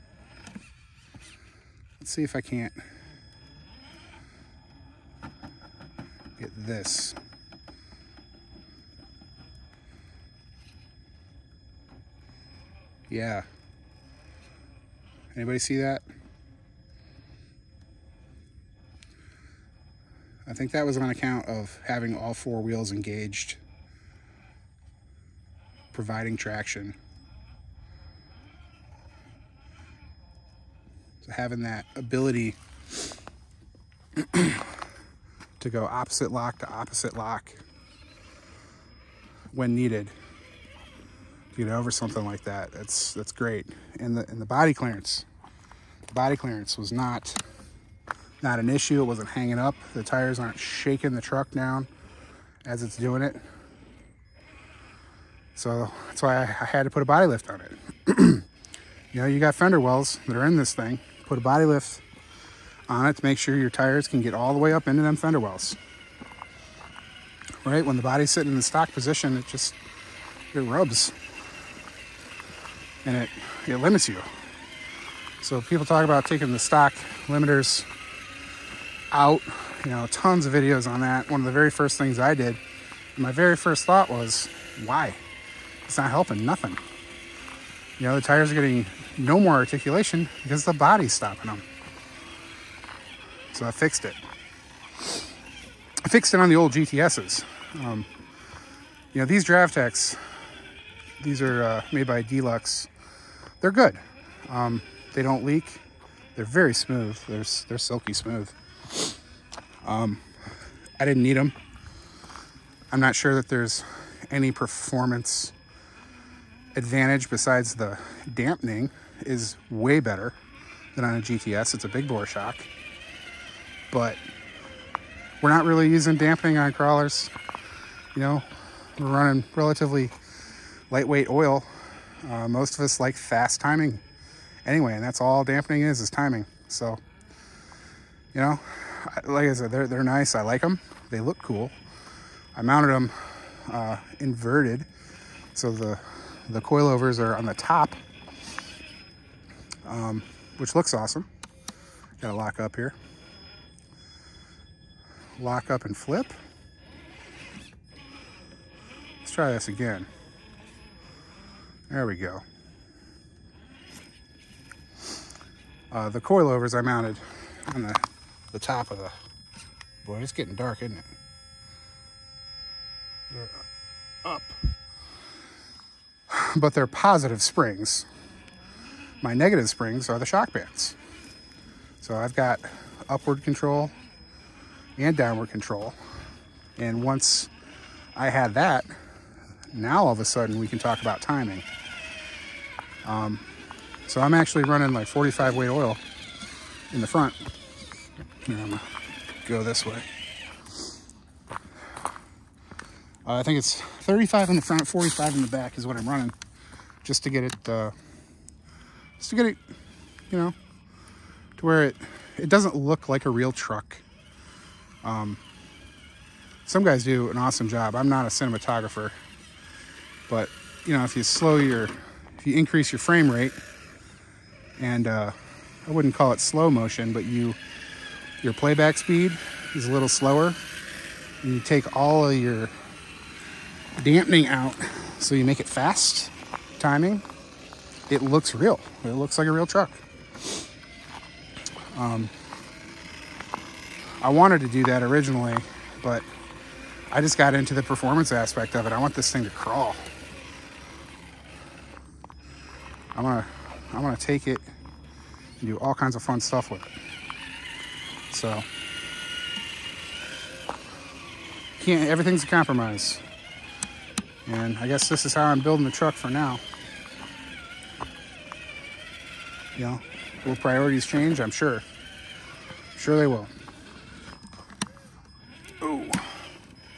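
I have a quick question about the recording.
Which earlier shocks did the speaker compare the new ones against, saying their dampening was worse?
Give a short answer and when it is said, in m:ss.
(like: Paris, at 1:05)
GTS, at 2:01.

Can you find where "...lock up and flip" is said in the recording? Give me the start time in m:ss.
2:35.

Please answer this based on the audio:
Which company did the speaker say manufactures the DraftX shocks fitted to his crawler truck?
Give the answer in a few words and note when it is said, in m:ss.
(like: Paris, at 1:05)
Deluxe, at 1:42.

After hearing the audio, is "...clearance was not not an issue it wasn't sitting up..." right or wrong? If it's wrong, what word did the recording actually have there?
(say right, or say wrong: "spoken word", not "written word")
wrong: "hanging", not "sitting".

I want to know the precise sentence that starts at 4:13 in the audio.
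I'm gonna, I'm gonna take it and do all kinds of fun stuff with it.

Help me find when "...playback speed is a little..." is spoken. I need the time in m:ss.
3:48.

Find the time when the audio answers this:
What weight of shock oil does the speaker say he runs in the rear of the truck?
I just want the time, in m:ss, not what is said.
3:24.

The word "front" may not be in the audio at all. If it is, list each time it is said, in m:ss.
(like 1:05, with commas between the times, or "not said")
3:17, 3:24.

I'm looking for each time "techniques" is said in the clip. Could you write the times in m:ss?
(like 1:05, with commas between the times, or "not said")
not said.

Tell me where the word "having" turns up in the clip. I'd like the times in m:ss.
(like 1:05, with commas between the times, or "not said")
0:21, 0:31.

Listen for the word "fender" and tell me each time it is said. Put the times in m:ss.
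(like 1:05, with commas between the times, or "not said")
0:59, 1:05.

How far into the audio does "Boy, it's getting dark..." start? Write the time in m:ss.
2:50.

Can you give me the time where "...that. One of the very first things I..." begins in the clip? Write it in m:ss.
1:21.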